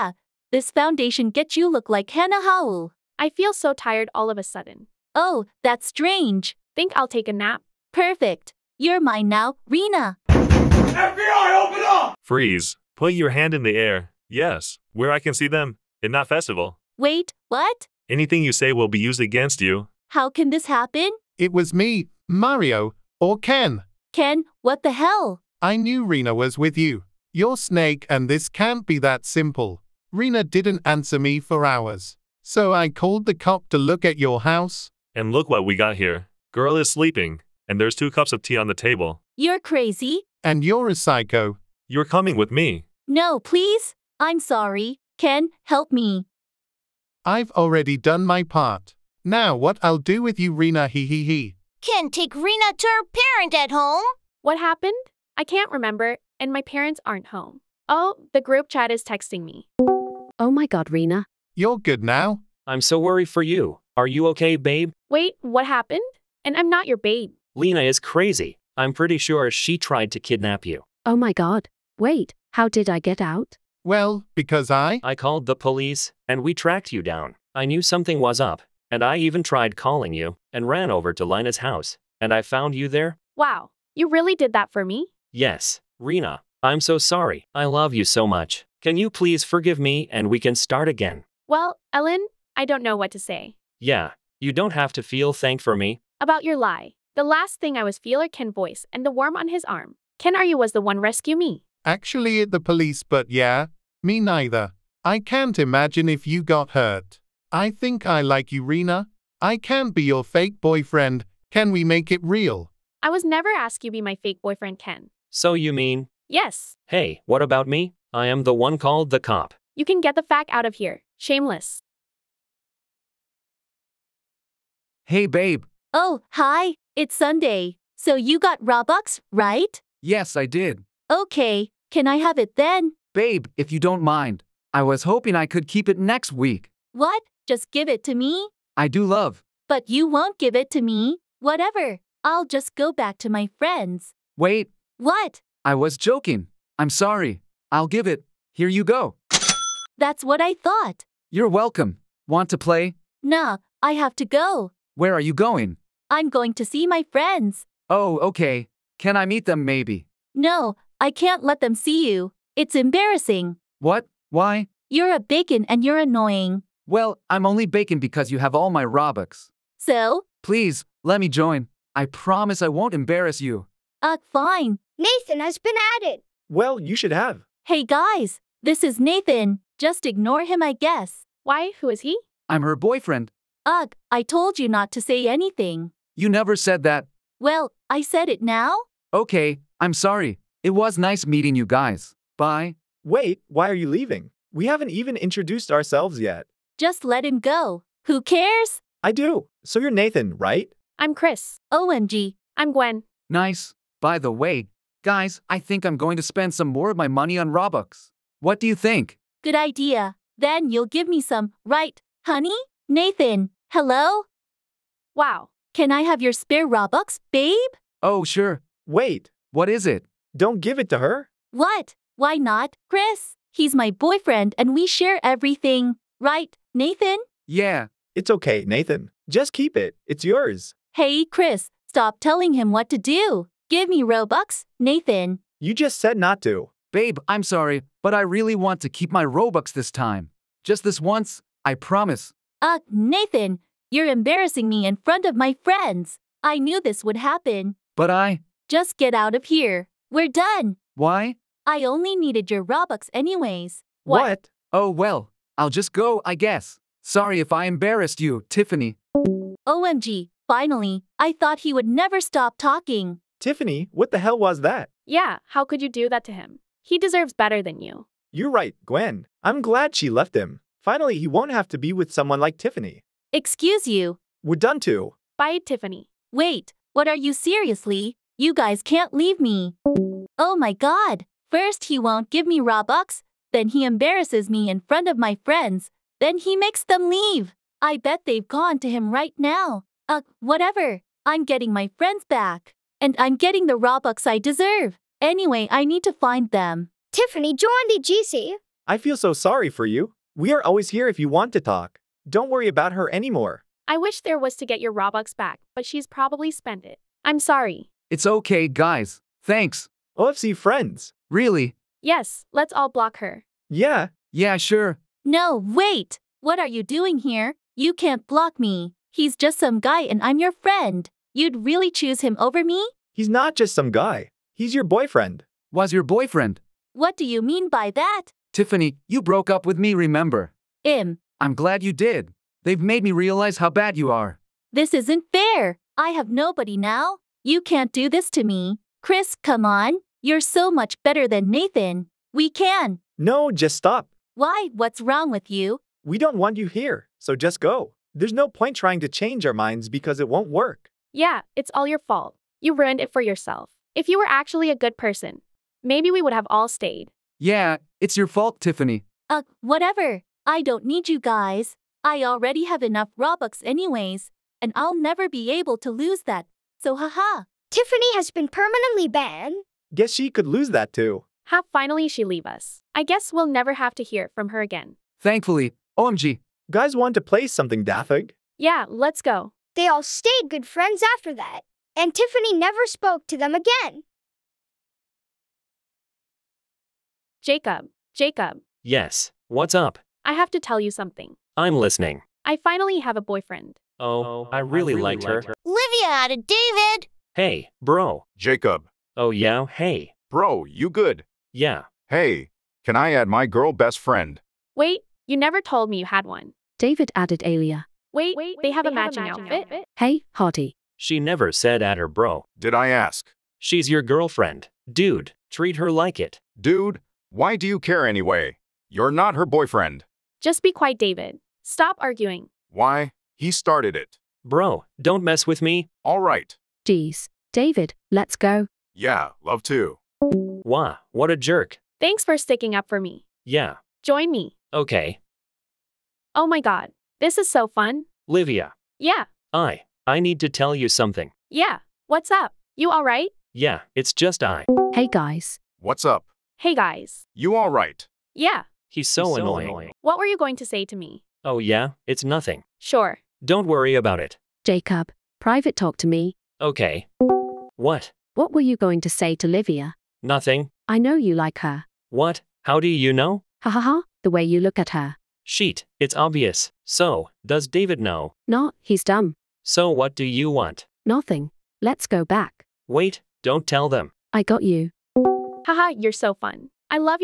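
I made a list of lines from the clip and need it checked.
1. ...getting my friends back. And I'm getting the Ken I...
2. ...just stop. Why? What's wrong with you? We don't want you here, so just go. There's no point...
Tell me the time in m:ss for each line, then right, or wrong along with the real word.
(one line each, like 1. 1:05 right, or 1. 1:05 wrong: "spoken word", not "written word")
1. 4:51 wrong: "Robux", not "Ken"
2. 5:43 right.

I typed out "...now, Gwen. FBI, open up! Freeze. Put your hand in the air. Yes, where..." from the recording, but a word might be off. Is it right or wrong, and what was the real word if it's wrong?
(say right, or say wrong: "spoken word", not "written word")
wrong: "Rena", not "Gwen".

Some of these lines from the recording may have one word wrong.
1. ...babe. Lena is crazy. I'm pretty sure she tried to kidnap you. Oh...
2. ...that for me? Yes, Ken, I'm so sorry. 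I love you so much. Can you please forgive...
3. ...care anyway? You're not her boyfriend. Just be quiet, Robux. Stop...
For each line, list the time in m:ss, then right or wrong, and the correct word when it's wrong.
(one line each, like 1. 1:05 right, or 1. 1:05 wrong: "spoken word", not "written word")
1. 1:06 right
2. 1:24 wrong: "Rena", not "Ken"
3. 6:57 wrong: "David", not "Robux".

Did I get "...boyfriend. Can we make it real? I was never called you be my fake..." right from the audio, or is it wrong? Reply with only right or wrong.
wrong.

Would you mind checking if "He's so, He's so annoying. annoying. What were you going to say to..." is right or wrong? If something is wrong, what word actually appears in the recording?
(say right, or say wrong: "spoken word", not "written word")
right.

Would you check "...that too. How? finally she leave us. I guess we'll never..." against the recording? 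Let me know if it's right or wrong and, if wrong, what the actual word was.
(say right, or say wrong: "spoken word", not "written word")
right.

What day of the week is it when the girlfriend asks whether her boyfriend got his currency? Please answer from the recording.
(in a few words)
Sunday.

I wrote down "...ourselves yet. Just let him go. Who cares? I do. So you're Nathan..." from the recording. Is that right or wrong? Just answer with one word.
right.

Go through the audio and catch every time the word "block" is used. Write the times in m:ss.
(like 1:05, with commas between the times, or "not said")
5:12, 5:18.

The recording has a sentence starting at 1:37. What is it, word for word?
The last thing I was feel or Ken voice and the worm on his arm.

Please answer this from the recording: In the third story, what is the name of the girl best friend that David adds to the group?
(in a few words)
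Alia.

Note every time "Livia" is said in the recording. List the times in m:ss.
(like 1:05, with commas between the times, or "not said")
6:35, 7:18, 7:39.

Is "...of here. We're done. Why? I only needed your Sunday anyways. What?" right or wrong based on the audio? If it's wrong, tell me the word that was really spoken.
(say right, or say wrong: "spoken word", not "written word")
wrong: "Robux", not "Sunday".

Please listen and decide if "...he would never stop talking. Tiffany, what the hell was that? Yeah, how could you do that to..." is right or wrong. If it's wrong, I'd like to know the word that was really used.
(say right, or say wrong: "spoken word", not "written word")
right.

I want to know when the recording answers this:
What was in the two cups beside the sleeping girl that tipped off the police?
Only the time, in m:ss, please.
0:37.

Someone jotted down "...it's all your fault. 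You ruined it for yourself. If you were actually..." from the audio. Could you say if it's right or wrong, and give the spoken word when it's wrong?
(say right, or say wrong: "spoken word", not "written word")
right.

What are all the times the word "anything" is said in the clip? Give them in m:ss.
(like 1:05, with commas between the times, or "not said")
0:18, 3:05.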